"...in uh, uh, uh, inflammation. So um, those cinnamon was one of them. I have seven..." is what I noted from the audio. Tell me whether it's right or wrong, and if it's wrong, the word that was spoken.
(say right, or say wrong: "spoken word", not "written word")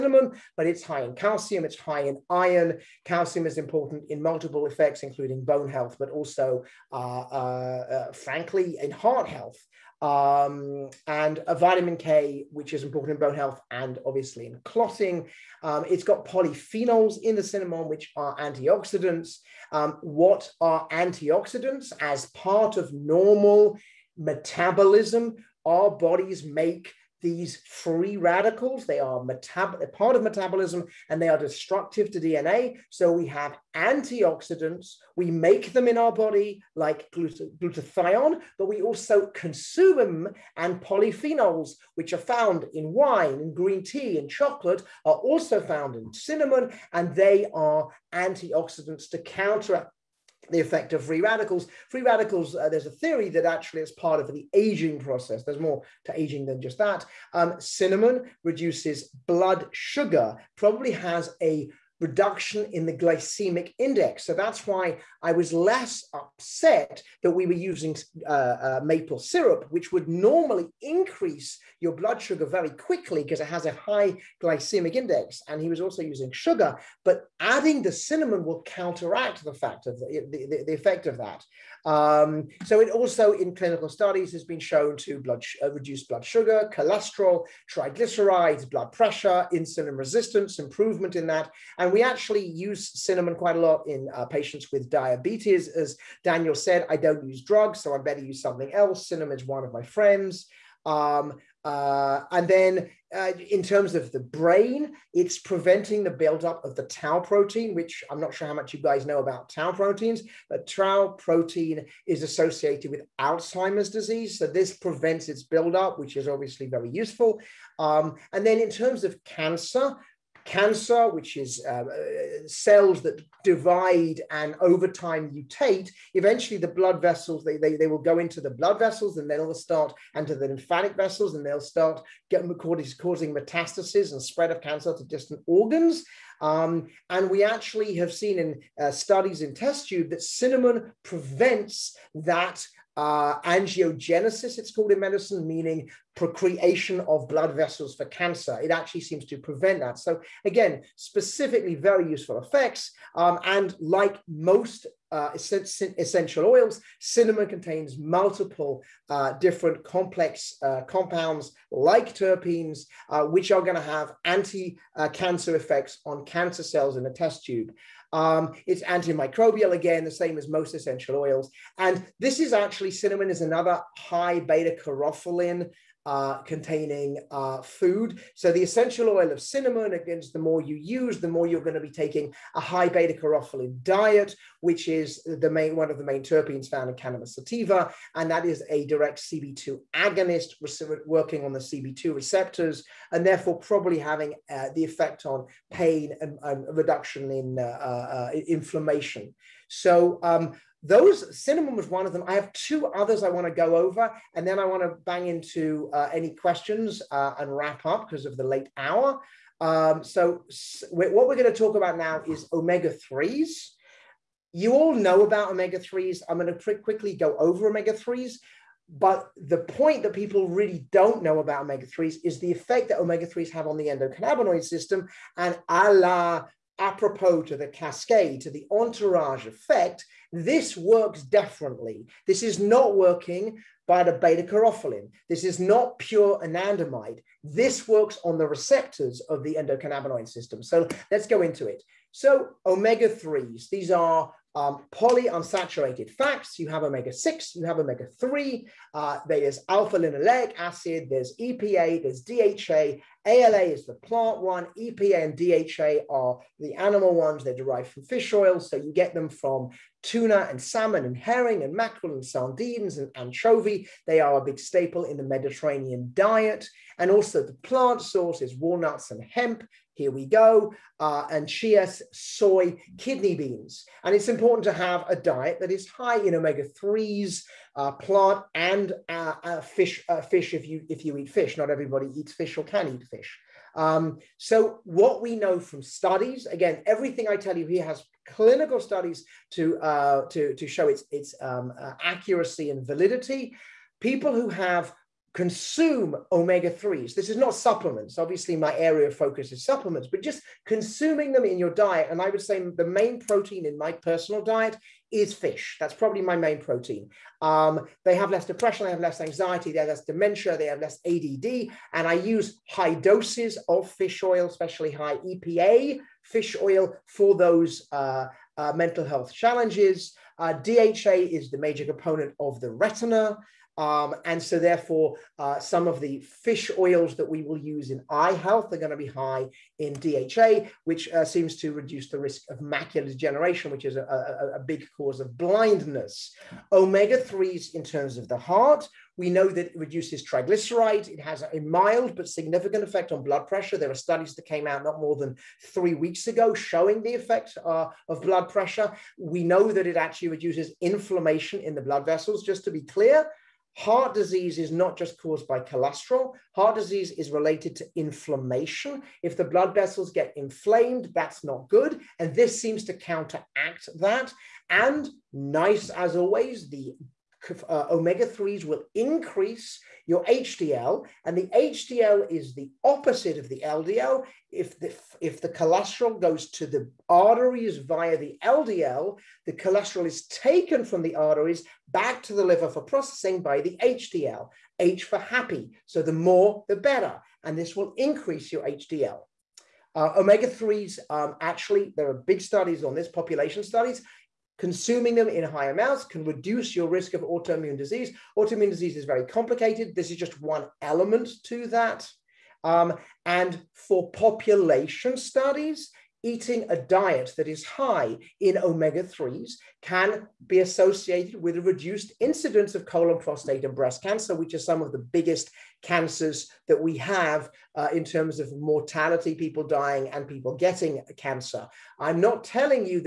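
wrong: "two", not "seven".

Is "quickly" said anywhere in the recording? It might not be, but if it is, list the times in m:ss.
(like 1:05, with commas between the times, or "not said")
1:12, 3:36.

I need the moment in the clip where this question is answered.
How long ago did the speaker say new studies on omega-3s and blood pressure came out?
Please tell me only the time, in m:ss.
5:45.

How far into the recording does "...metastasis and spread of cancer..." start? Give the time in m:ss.
2:13.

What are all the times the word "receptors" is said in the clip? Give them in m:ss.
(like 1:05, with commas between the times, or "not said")
3:12, 3:58.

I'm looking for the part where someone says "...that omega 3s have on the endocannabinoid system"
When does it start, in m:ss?
3:42.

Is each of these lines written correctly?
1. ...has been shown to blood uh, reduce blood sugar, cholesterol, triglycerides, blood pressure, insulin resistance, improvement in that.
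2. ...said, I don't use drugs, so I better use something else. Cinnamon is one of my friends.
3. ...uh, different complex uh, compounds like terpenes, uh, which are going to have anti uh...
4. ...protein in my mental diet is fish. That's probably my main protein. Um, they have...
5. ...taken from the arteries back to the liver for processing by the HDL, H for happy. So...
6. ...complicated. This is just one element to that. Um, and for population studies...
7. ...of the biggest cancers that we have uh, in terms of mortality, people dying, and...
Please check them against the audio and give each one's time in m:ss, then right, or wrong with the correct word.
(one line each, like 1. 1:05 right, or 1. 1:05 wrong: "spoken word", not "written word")
1. 1:24 right
2. 1:36 right
3. 2:39 right
4. 5:03 wrong: "personal", not "mental"
5. 6:20 right
6. 6:39 right
7. 6:54 right.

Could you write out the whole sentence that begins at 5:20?
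Uh, DHA is the major component of the retina.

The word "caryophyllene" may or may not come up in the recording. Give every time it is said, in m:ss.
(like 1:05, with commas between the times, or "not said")
2:54, 3:54.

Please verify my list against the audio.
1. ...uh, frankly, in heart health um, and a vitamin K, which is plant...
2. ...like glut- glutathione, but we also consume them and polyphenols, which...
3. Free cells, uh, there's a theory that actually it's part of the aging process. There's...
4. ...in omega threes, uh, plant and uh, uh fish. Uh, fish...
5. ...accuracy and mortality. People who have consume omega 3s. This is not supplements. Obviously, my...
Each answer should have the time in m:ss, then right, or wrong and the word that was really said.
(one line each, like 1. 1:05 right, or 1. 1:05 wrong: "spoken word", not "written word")
1. 0:08 wrong: "important", not "plant"
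2. 0:36 right
3. 0:51 wrong: "radicals", not "cells"
4. 4:36 right
5. 4:52 wrong: "validity", not "mortality".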